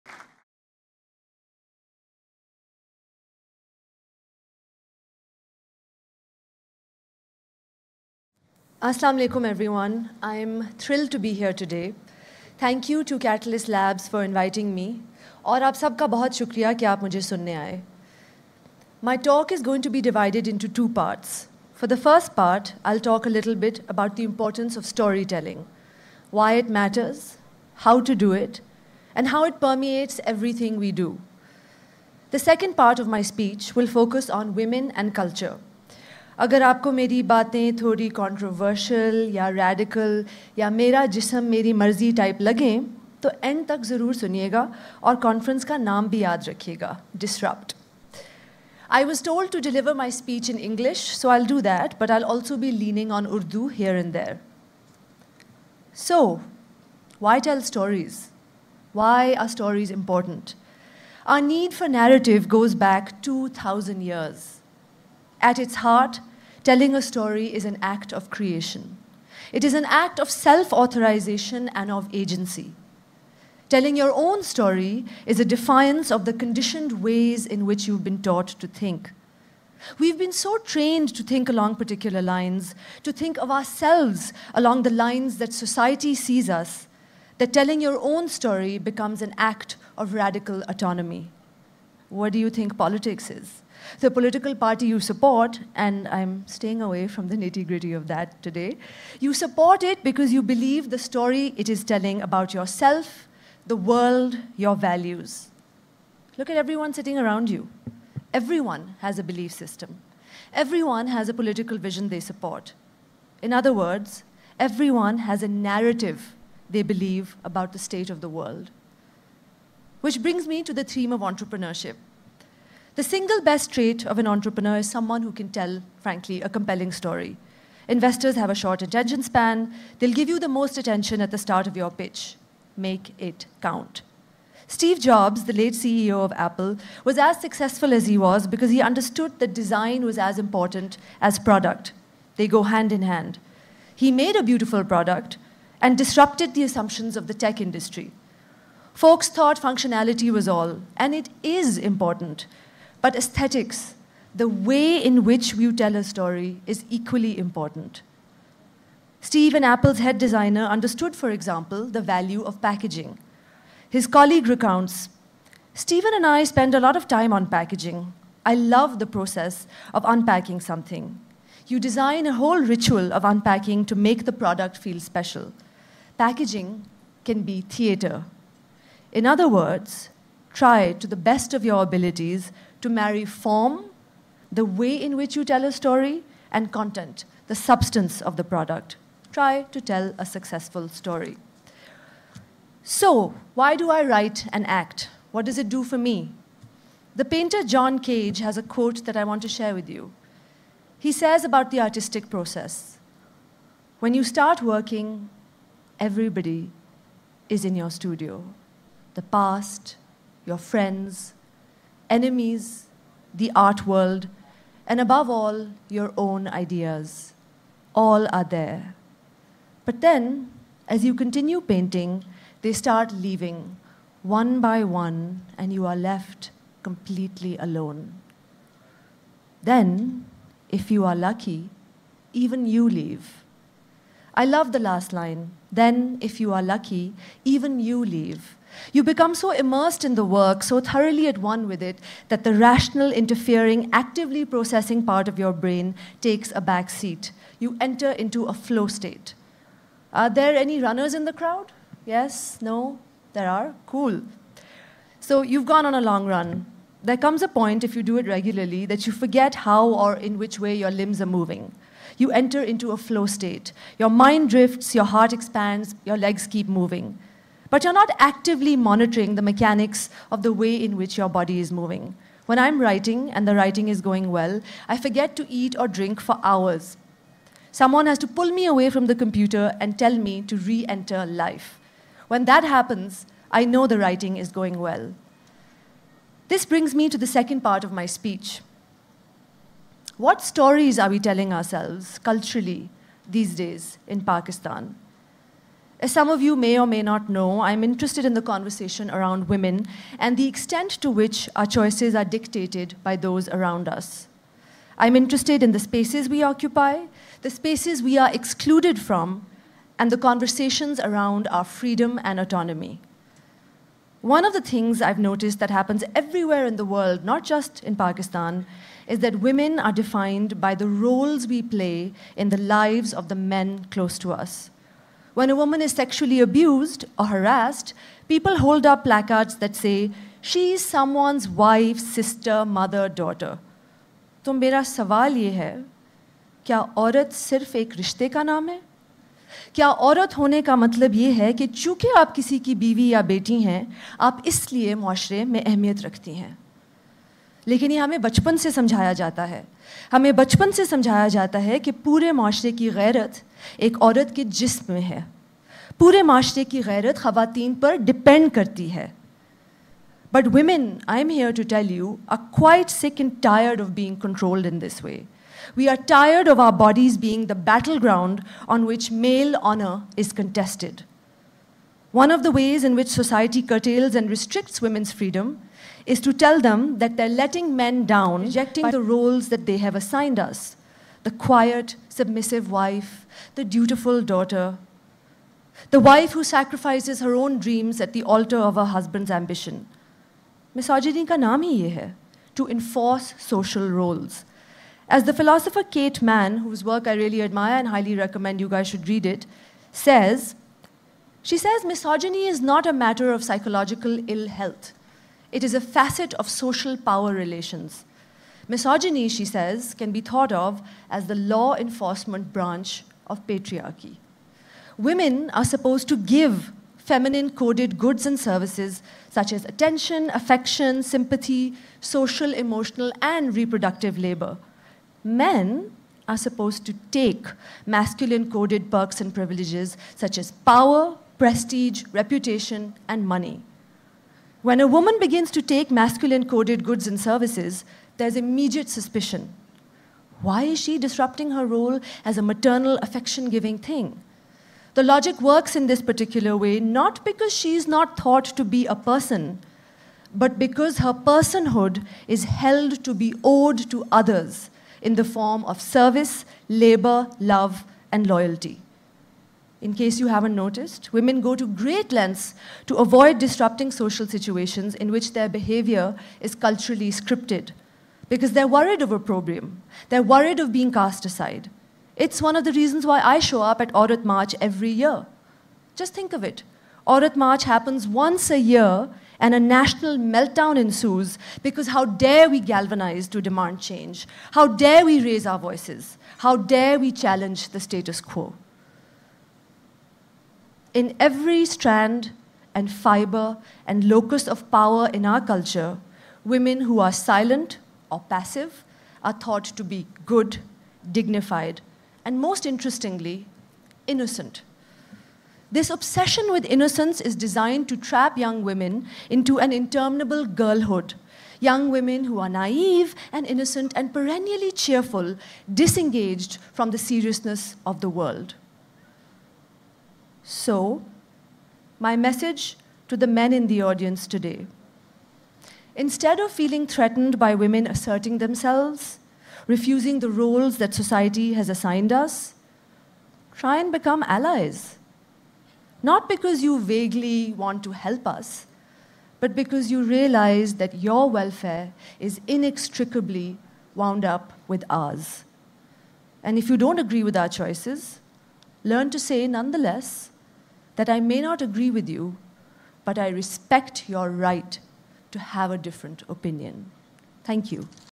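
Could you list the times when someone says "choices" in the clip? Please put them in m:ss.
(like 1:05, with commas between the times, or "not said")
5:01, 9:07.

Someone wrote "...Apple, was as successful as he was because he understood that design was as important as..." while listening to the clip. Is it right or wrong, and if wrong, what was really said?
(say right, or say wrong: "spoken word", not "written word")
right.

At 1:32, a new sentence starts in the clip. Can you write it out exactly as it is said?
What do you think politics is?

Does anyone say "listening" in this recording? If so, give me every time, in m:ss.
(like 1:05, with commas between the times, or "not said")
0:17.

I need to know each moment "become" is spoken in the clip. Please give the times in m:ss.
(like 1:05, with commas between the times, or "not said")
1:28, 3:59, 8:53.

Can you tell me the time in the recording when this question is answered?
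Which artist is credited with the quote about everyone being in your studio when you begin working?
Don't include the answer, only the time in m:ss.
3:17.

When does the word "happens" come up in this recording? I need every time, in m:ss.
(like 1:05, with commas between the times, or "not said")
4:42, 5:15, 7:57.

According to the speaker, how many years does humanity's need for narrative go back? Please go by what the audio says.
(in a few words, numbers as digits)
2,000.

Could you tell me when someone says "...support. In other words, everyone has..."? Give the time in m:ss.
1:52.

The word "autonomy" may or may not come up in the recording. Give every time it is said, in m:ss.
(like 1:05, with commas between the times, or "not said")
1:30, 5:12.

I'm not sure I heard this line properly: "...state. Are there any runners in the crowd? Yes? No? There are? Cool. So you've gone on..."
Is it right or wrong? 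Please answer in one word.
right.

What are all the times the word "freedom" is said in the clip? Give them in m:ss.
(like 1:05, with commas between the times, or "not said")
5:11, 6:15.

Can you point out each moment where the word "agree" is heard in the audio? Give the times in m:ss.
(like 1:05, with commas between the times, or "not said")
9:06, 9:11.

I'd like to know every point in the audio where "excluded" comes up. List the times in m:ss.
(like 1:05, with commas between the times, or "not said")
5:08.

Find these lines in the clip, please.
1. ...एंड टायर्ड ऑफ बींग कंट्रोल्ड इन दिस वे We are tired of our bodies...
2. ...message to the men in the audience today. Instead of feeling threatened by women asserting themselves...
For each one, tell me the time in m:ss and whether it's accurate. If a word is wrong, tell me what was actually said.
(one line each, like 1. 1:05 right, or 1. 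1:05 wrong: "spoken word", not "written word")
1. 6:03 right
2. 8:42 right.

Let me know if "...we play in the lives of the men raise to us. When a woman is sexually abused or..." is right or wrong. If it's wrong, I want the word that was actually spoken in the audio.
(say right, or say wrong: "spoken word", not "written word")
wrong: "close", not "raise".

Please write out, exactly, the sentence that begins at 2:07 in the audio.
Investors have a short attention span.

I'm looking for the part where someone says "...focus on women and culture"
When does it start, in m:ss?
0:34.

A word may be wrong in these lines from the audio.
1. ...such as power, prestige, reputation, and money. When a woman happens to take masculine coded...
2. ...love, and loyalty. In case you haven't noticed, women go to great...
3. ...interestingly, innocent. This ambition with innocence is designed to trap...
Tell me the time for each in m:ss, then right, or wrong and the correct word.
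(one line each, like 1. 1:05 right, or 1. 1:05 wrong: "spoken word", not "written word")
1. 7:10 wrong: "begins", not "happens"
2. 7:37 right
3. 8:22 wrong: "obsession", not "ambition".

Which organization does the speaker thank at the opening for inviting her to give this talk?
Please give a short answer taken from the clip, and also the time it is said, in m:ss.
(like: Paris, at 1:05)
Katalyst Labs, at 0:13.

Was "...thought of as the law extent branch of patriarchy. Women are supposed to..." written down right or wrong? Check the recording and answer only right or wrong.
wrong.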